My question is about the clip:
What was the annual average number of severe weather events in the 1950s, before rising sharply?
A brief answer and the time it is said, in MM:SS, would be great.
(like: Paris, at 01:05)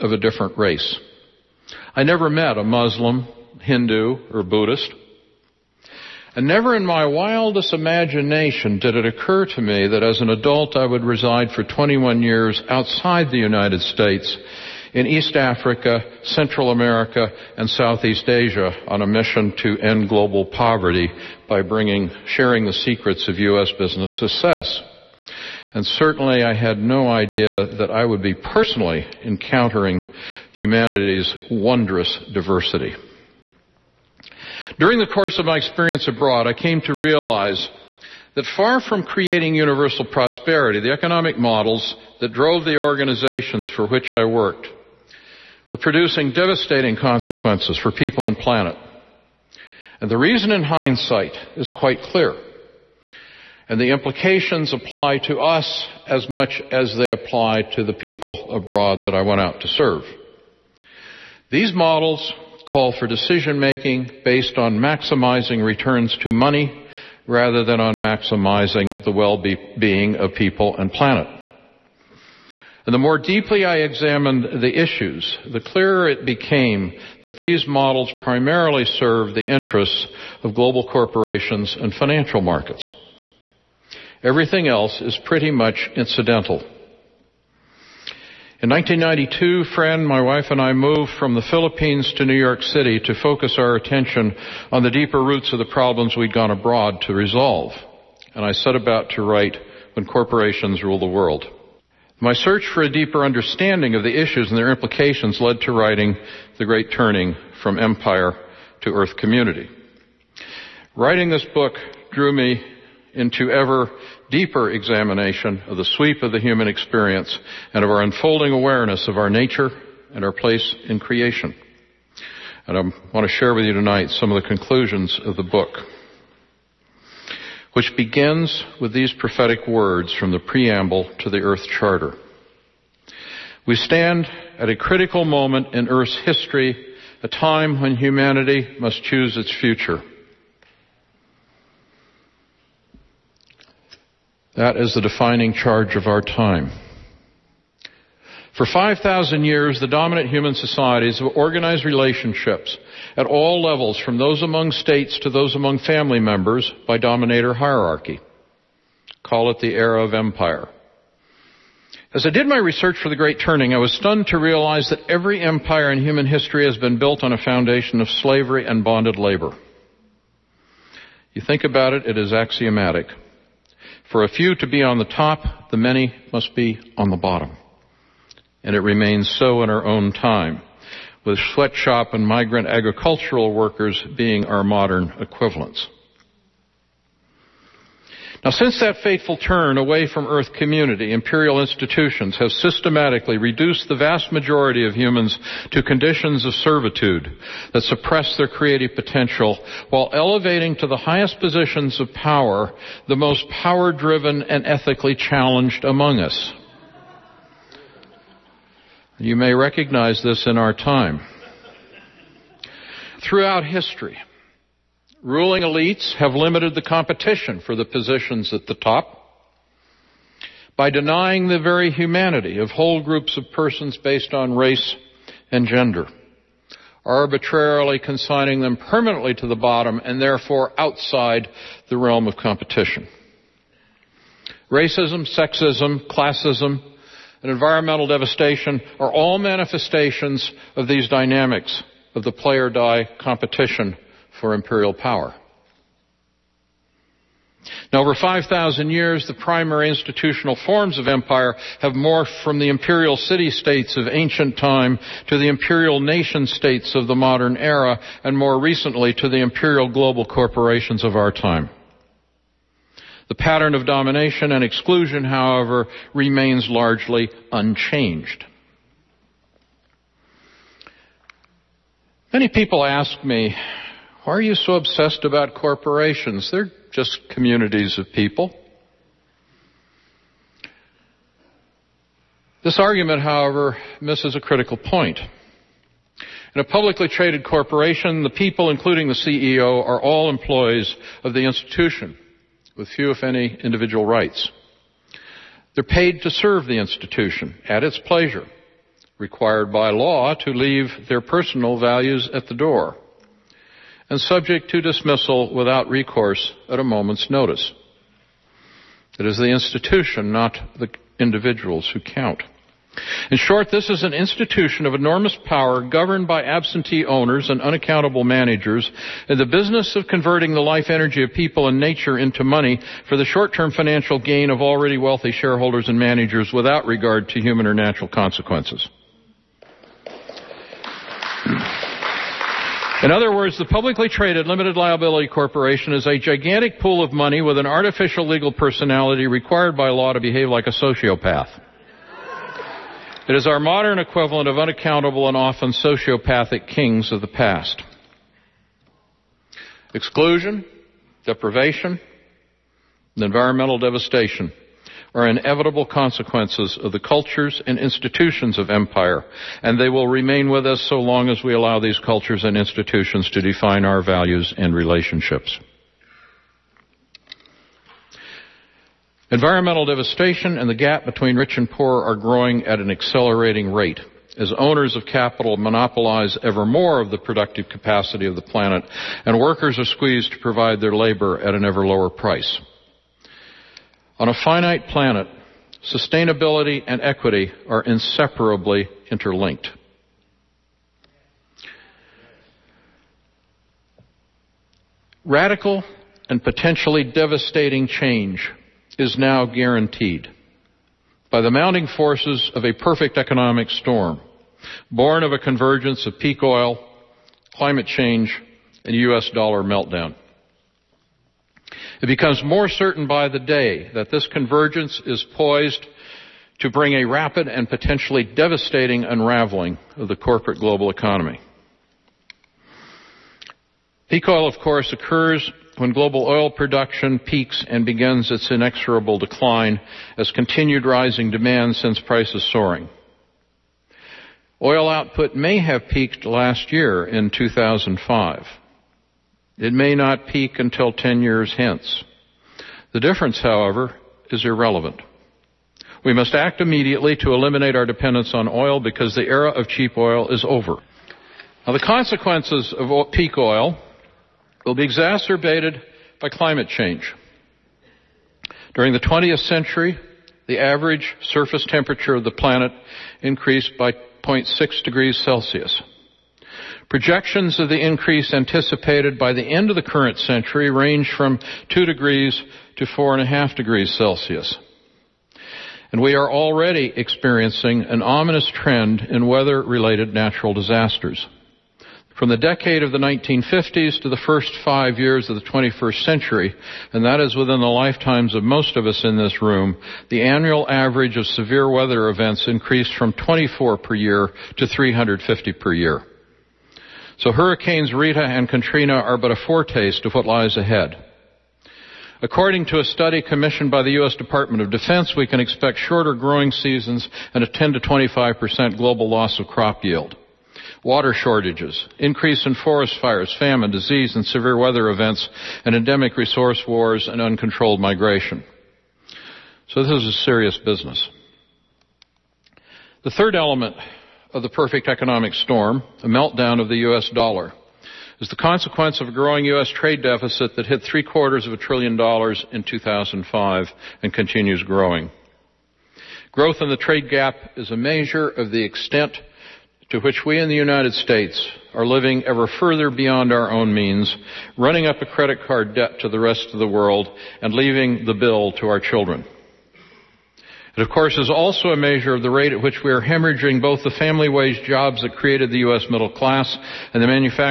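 24, at 08:13.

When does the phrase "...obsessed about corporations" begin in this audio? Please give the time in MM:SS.
04:34.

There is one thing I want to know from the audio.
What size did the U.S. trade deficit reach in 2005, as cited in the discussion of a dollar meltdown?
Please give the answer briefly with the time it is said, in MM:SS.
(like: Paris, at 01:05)
three quarters of a trillion dollars, at 08:50.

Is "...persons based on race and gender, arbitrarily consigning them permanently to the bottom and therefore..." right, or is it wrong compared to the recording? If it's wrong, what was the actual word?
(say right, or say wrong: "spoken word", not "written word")
right.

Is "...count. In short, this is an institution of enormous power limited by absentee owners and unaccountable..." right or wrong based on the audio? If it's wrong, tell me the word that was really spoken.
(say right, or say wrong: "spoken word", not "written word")
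wrong: "governed", not "limited".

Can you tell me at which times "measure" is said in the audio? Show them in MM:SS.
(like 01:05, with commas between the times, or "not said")
08:57, 09:11.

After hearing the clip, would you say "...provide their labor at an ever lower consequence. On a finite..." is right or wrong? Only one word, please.
wrong.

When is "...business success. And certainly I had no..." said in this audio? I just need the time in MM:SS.
00:23.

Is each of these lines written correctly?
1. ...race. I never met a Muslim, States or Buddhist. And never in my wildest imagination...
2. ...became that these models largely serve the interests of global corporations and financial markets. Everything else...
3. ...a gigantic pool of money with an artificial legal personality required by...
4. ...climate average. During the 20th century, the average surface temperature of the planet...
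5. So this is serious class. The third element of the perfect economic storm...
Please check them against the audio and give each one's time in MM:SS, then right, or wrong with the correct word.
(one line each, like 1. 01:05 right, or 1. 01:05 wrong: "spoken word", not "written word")
1. 00:00 wrong: "Hindu", not "States"
2. 01:16 wrong: "primarily", not "largely"
3. 05:36 right
4. 07:36 wrong: "change", not "average"
5. 08:39 wrong: "business", not "class".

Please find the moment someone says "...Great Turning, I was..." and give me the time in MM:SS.
02:43.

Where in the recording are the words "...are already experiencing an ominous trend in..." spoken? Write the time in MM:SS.
07:56.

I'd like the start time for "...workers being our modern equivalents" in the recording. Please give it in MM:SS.
03:03.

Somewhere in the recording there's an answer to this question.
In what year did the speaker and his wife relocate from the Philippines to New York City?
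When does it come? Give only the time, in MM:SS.
01:28.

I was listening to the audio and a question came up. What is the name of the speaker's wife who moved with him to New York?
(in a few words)
Fran.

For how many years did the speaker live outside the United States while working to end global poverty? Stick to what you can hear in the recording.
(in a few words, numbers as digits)
21.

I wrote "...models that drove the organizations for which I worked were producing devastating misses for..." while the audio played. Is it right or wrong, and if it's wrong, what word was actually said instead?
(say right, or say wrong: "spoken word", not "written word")
wrong: "consequences", not "misses".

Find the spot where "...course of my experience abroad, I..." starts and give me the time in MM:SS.
00:35.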